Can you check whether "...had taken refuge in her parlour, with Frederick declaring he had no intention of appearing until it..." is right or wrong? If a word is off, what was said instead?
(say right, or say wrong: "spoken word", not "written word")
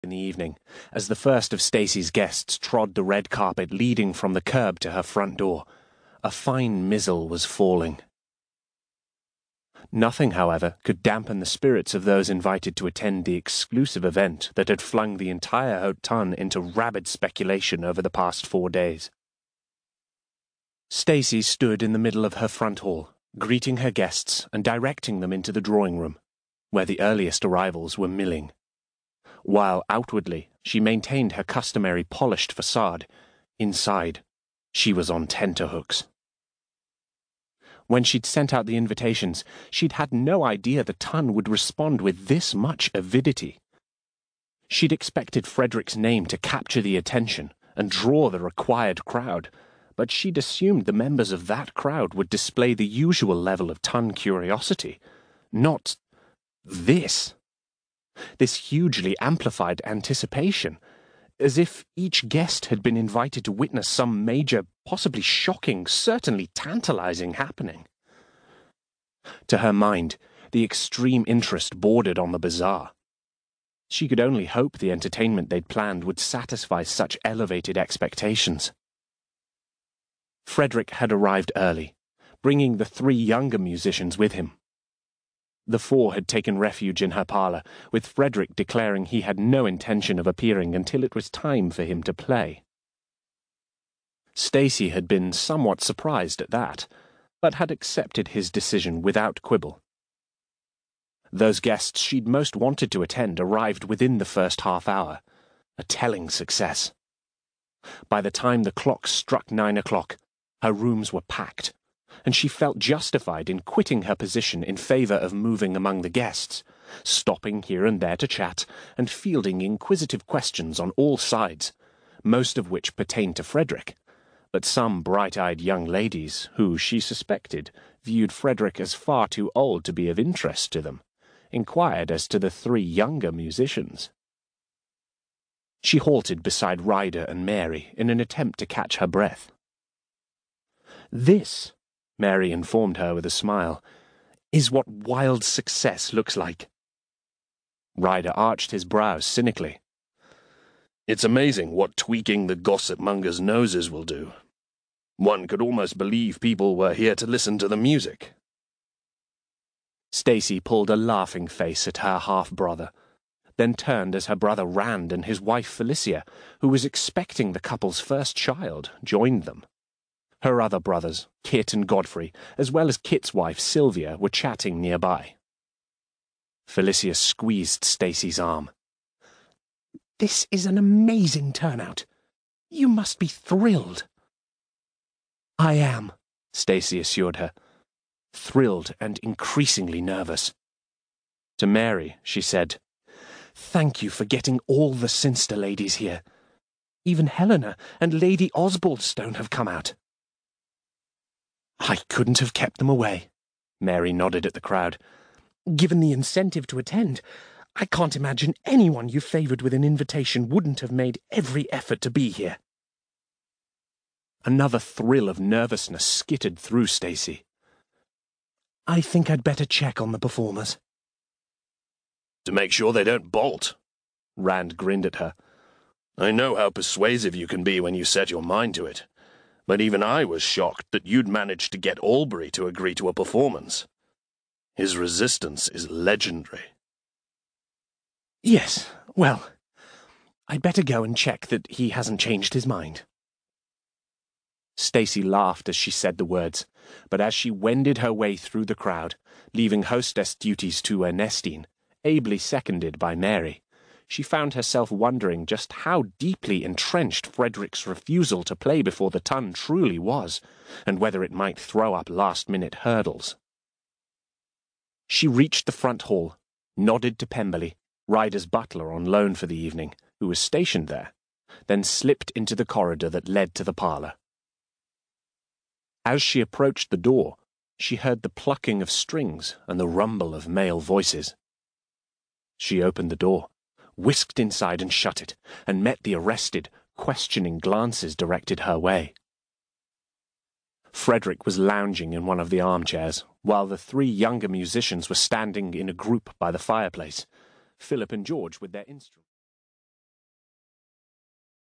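right.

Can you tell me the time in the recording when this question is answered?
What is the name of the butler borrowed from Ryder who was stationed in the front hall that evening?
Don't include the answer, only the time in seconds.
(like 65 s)
267 s.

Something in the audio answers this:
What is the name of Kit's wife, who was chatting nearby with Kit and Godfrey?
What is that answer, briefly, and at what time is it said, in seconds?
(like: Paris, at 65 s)
Sylvia, at 173 s.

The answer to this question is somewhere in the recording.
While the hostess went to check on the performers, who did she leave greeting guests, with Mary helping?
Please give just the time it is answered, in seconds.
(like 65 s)
251 s.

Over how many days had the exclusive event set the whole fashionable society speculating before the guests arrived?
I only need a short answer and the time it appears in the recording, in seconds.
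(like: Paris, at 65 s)
4, at 18 s.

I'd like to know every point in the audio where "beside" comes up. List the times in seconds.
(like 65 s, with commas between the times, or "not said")
136 s.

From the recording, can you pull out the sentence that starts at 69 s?
To her mind, the extreme interest bordered on the bizarre.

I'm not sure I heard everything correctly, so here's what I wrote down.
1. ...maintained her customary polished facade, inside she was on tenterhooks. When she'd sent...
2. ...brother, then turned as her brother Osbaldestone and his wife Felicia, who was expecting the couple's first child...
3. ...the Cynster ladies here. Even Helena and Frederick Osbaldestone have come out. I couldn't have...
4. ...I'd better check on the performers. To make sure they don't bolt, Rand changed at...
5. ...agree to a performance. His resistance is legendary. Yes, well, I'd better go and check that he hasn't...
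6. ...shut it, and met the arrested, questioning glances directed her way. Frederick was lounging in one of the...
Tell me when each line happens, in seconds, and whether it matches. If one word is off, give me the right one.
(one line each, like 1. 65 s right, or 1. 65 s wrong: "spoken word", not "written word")
1. 30 s right
2. 162 s wrong: "Rand", not "Osbaldestone"
3. 194 s wrong: "Lady", not "Frederick"
4. 219 s wrong: "grinned", not "changed"
5. 232 s right
6. 284 s right.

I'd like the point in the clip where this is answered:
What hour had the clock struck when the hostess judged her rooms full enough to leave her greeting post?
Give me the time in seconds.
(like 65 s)
109 s.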